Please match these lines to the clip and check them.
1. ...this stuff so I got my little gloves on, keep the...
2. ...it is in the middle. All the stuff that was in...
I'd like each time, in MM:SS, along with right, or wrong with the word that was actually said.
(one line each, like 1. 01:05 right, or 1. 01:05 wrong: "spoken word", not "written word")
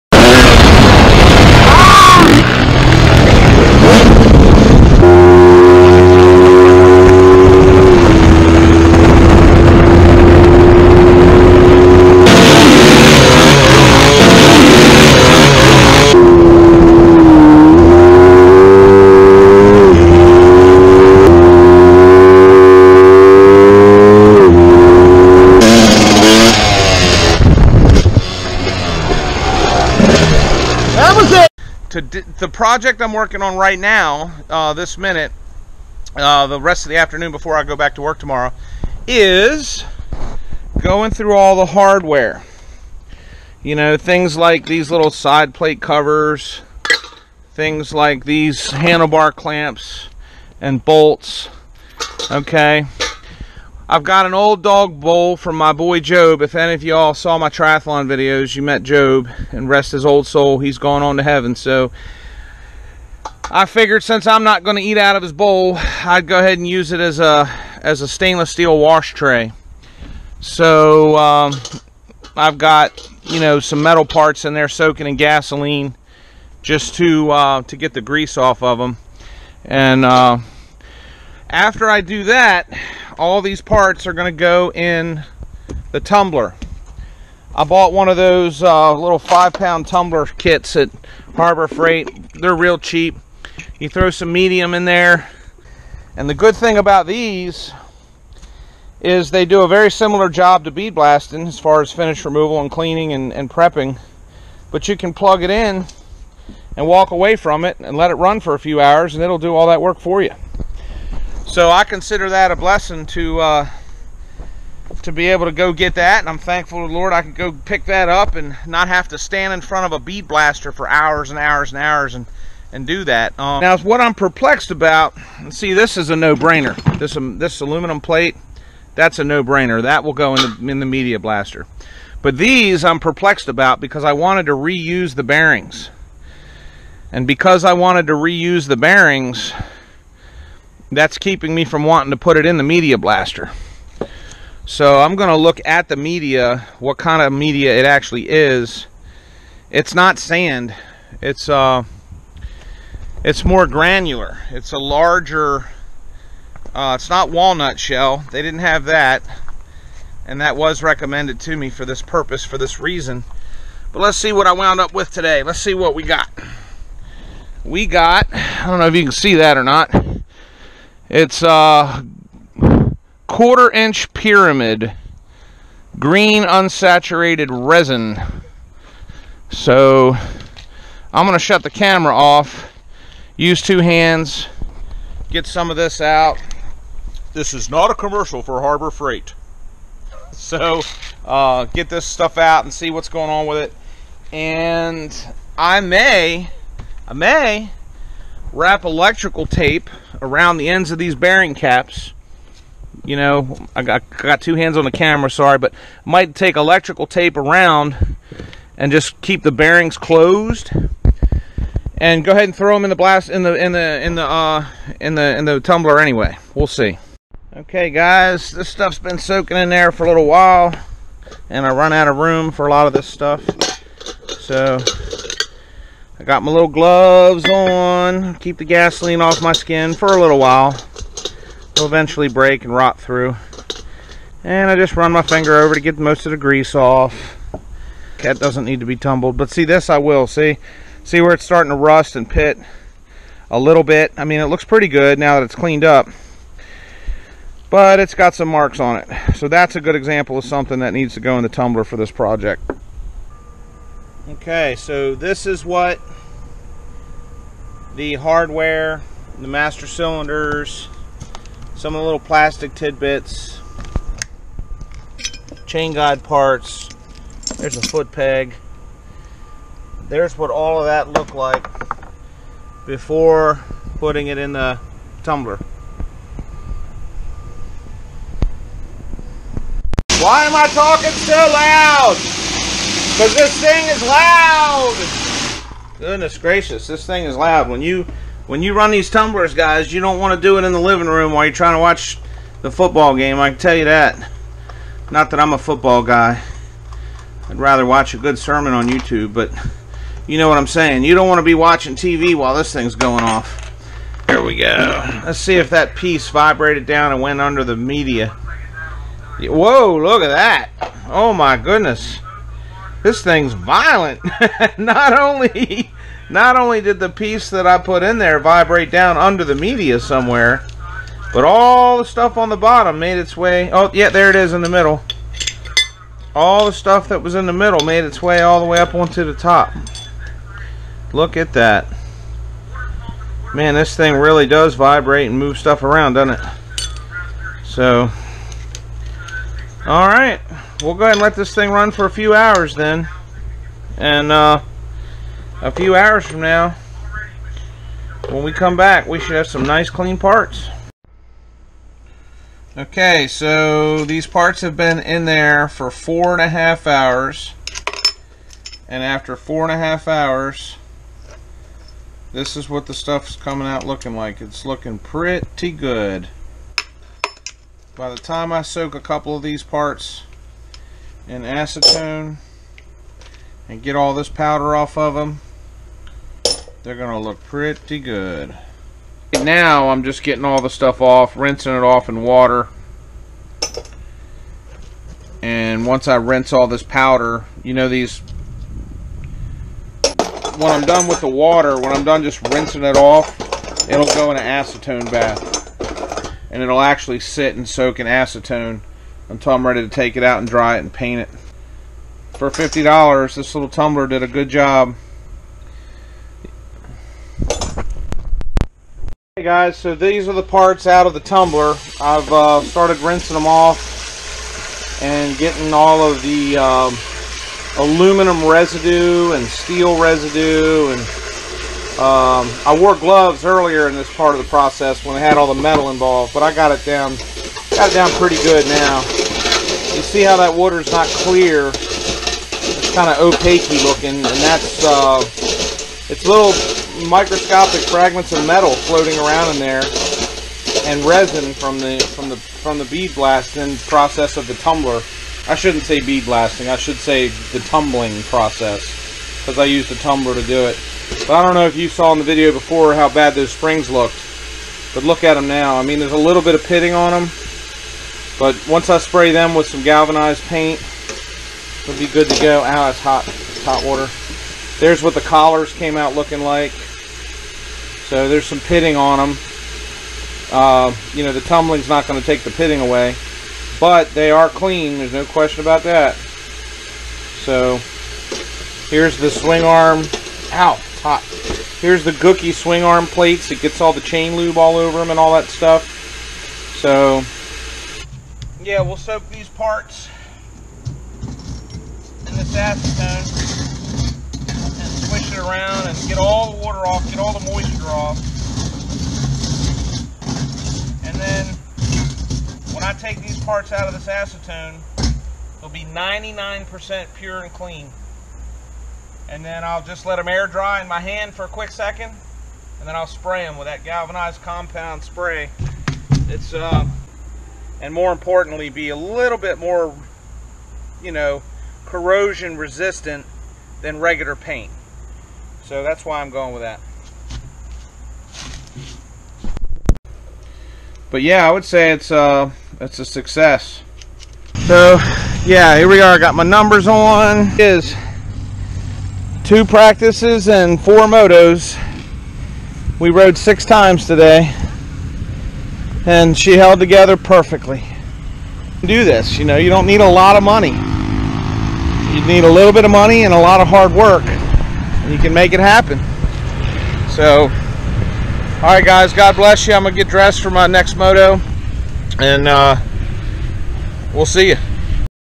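1. 03:42 right
2. 05:24 right.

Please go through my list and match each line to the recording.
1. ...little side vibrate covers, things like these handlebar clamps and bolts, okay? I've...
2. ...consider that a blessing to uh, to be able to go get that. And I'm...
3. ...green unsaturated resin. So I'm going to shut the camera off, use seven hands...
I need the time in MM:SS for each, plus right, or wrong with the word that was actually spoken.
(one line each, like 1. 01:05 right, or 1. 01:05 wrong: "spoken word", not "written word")
1. 00:44 wrong: "plate", not "vibrate"
2. 01:51 right
3. 02:55 wrong: "two", not "seven".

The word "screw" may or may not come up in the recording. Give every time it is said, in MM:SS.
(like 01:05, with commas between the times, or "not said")
not said.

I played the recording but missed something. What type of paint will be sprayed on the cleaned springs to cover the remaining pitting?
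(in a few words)
galvanized paint.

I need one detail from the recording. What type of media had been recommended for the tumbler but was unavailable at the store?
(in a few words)
walnut shell.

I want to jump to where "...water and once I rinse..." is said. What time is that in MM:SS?
06:22.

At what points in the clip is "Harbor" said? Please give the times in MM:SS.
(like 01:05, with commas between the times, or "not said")
01:31, 03:08.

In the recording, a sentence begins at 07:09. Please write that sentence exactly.
You see how that water is not clear.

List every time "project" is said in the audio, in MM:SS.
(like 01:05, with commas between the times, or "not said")
00:32, 04:12.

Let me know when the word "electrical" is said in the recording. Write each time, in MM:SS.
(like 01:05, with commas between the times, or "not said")
03:18, 03:26.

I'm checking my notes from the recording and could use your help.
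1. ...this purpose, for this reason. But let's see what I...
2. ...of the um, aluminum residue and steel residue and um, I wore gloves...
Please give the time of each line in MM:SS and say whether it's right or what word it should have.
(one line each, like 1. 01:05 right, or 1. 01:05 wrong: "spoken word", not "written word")
1. 02:41 right
2. 06:56 right.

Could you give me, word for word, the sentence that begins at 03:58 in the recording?
That doesn't need to be tumbled, but see this I will, see?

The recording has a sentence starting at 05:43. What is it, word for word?
And uh, a few hours from now, when we come back, we should have some nice clean parts.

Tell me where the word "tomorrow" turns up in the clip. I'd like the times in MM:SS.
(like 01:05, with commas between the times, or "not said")
00:38.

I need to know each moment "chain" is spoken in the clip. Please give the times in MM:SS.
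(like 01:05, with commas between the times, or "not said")
04:25, 08:04.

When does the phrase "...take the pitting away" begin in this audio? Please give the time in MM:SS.
07:52.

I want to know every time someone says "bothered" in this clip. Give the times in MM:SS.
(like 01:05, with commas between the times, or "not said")
not said.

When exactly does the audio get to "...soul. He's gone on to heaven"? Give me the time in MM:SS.
01:00.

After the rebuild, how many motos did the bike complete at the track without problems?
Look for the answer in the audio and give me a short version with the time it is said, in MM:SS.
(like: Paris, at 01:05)
4, at 09:00.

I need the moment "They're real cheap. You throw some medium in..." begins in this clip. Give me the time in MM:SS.
01:32.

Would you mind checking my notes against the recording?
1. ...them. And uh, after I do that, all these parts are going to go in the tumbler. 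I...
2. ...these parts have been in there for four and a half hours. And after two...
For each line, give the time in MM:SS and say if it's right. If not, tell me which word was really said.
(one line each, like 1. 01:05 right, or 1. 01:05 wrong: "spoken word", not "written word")
1. 01:18 right
2. 05:54 wrong: "four", not "two".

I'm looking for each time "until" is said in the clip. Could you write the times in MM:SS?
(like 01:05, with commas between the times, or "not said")
06:39.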